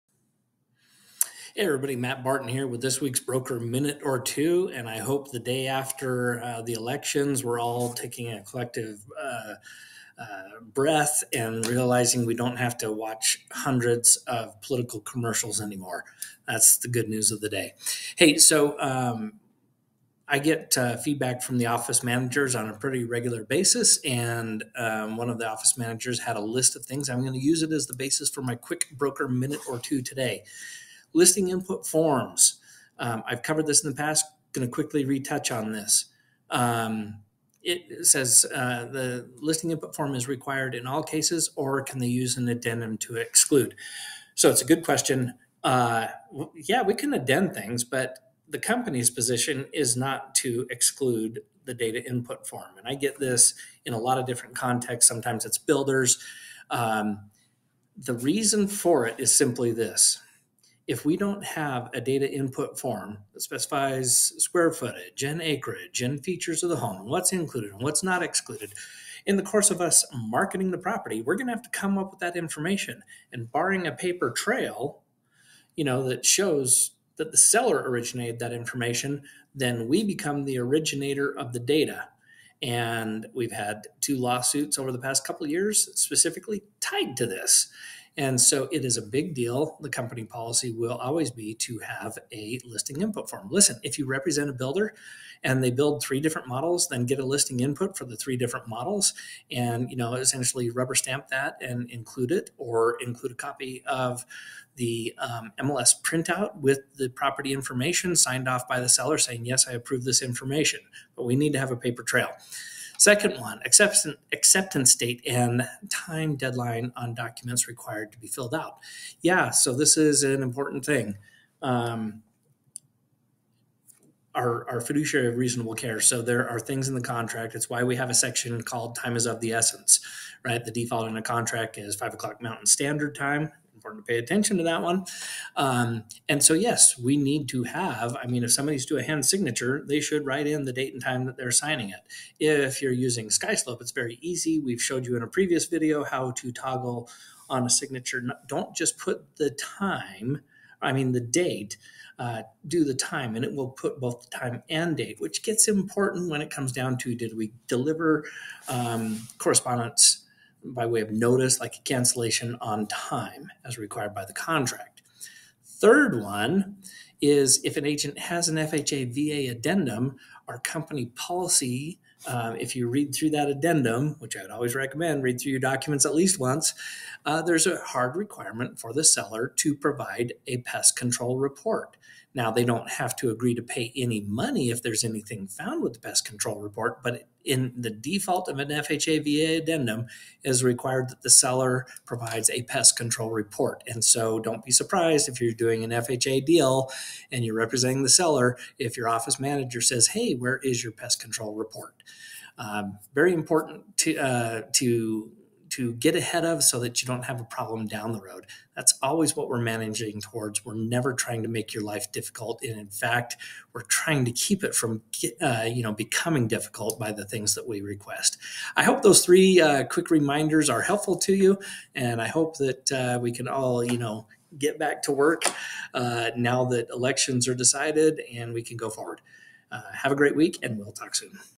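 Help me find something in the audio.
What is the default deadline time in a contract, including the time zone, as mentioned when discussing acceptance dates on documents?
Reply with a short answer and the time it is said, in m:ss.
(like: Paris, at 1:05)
5:00 Mountain Standard Time, at 2:11.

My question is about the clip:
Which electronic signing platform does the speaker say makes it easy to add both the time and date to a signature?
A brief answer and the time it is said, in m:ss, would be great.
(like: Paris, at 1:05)
Skyslope, at 2:23.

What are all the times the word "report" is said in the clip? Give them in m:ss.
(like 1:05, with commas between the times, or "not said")
3:01, 3:06, 3:13, 3:21.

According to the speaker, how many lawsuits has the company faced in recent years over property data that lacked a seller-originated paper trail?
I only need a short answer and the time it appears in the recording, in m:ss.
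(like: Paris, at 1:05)
2, at 1:24.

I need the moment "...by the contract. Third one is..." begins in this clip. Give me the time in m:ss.
2:44.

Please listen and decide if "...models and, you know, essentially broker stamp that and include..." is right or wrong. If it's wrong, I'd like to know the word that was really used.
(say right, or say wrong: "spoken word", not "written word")
wrong: "rubber", not "broker".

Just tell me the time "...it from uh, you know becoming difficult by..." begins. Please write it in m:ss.
3:34.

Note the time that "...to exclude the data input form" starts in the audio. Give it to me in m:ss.
0:50.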